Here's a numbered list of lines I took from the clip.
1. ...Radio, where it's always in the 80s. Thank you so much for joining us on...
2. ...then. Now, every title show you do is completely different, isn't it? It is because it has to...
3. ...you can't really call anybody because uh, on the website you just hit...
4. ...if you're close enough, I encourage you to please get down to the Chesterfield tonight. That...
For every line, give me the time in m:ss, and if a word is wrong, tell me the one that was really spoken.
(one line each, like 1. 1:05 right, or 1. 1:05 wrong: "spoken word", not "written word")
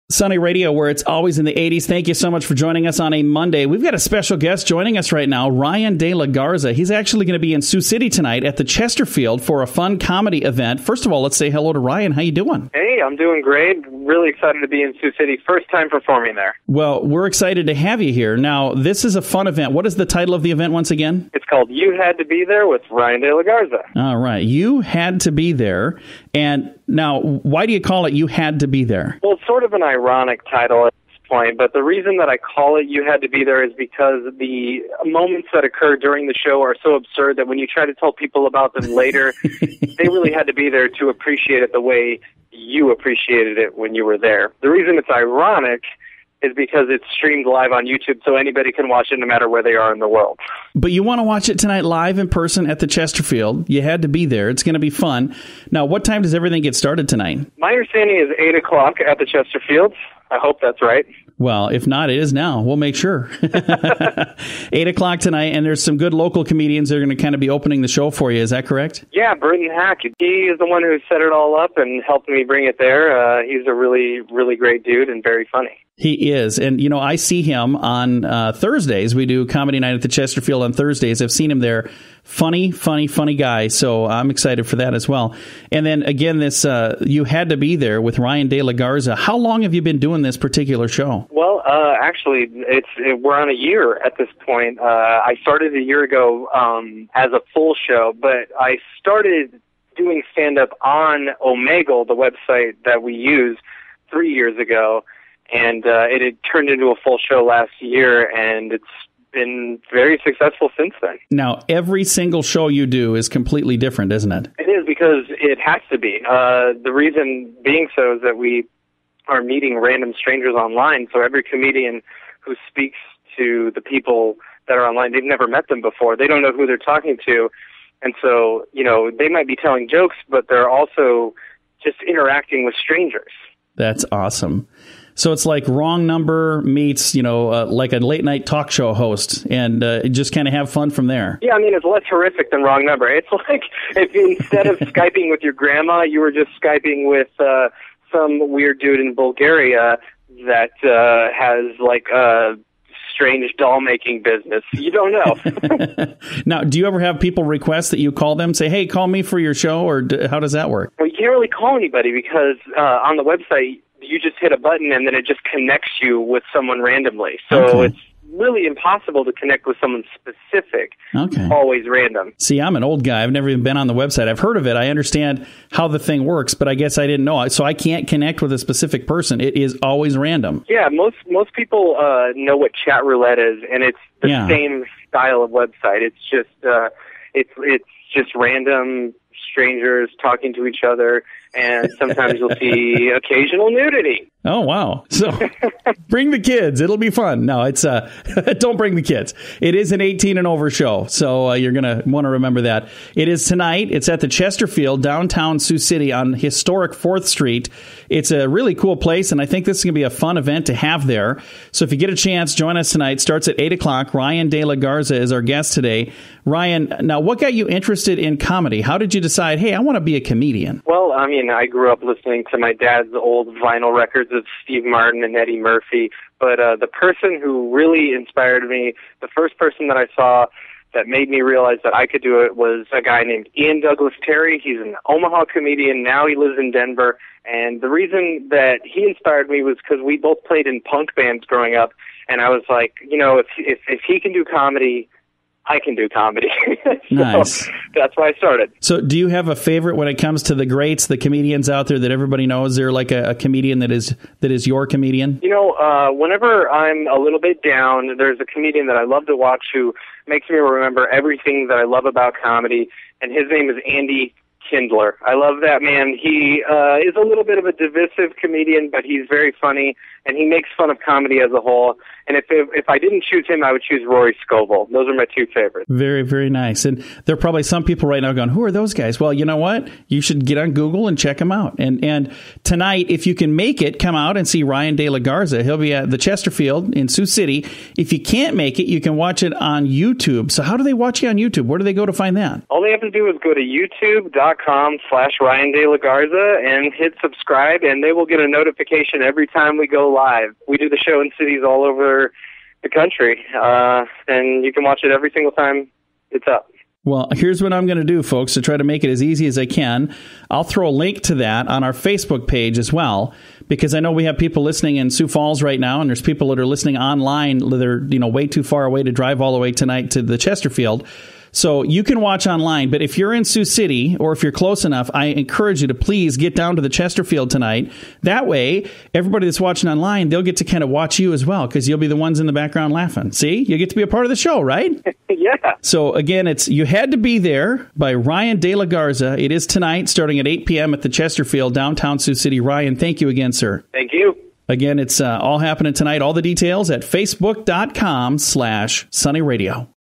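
1. 0:00 right
2. 1:51 wrong: "single", not "title"
3. 2:41 right
4. 5:24 right.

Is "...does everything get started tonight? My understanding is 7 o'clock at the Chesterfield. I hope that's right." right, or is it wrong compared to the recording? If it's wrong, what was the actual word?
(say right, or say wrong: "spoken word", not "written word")
wrong: "8", not "7".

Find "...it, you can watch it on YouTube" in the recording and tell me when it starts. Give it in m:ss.
4:48.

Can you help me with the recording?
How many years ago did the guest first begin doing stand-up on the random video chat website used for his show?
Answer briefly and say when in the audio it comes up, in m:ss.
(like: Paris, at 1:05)
3, at 1:44.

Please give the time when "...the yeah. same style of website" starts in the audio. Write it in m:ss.
3:04.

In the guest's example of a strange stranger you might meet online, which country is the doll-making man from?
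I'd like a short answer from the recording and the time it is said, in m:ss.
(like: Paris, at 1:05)
Bulgaria, at 2:29.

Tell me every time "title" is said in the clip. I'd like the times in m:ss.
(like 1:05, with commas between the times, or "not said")
0:20, 0:30.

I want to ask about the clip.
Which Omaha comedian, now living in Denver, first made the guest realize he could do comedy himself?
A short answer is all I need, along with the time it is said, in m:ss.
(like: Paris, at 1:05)
Ian Douglas Terry, at 3:53.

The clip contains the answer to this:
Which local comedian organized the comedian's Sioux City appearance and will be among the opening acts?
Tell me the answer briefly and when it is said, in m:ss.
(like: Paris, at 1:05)
Burton Hack, at 1:09.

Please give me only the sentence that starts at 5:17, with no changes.
They're you know way too far away to drive all the way tonight to the Chesterfield.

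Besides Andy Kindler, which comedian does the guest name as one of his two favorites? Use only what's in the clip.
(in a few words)
Rory Scovel.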